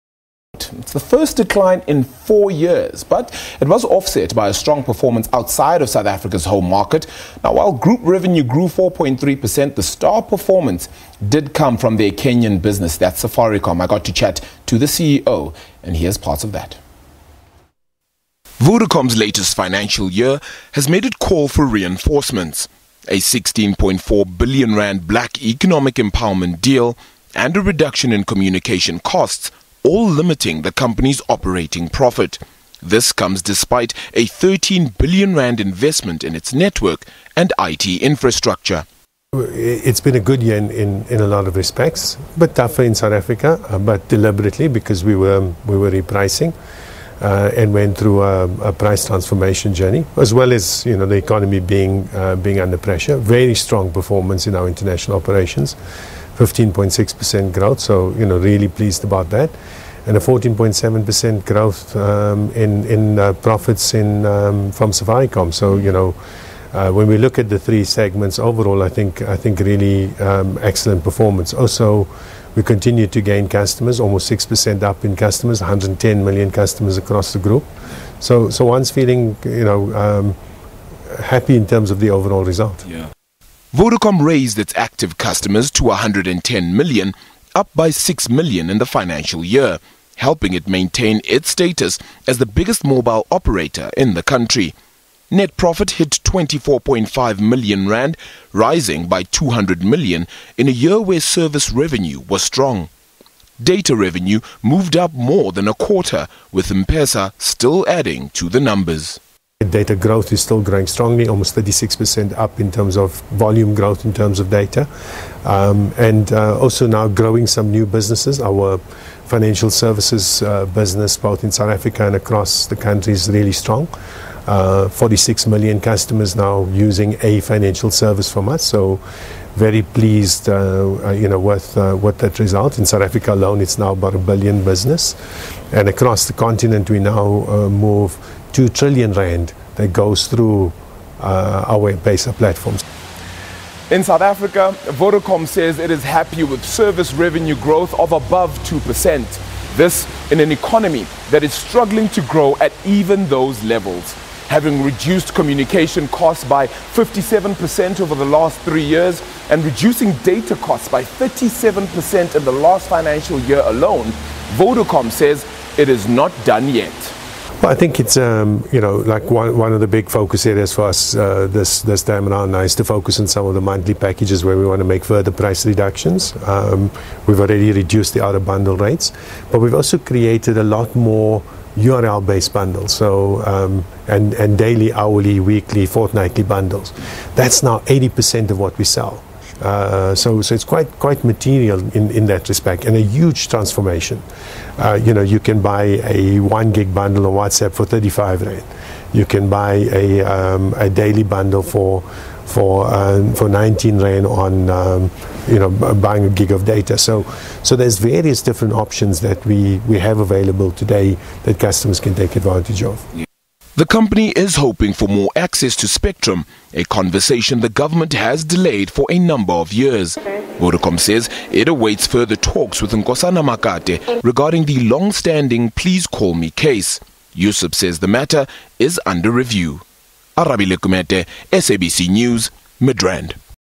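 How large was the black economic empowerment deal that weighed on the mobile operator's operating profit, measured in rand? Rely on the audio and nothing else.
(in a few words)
16.4 billion rand.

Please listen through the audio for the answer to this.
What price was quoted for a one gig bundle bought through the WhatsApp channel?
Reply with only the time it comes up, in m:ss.
3:17.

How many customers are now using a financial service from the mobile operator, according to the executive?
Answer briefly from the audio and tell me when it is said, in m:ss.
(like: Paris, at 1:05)
46 million, at 2:04.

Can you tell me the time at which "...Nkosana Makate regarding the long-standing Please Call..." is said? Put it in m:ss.
3:42.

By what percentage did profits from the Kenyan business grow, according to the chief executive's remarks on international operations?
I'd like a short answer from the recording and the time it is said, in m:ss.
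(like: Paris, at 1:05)
14.7%, at 1:00.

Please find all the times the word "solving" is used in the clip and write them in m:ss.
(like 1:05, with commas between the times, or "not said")
not said.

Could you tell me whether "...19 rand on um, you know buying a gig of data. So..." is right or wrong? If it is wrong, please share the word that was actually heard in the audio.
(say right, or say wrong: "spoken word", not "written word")
right.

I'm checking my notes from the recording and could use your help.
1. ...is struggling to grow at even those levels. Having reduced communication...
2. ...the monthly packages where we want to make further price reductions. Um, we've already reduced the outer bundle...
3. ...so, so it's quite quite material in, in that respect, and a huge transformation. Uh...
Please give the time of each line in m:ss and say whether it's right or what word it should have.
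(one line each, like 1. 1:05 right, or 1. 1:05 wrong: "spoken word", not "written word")
1. 2:31 right
2. 2:53 right
3. 3:10 right.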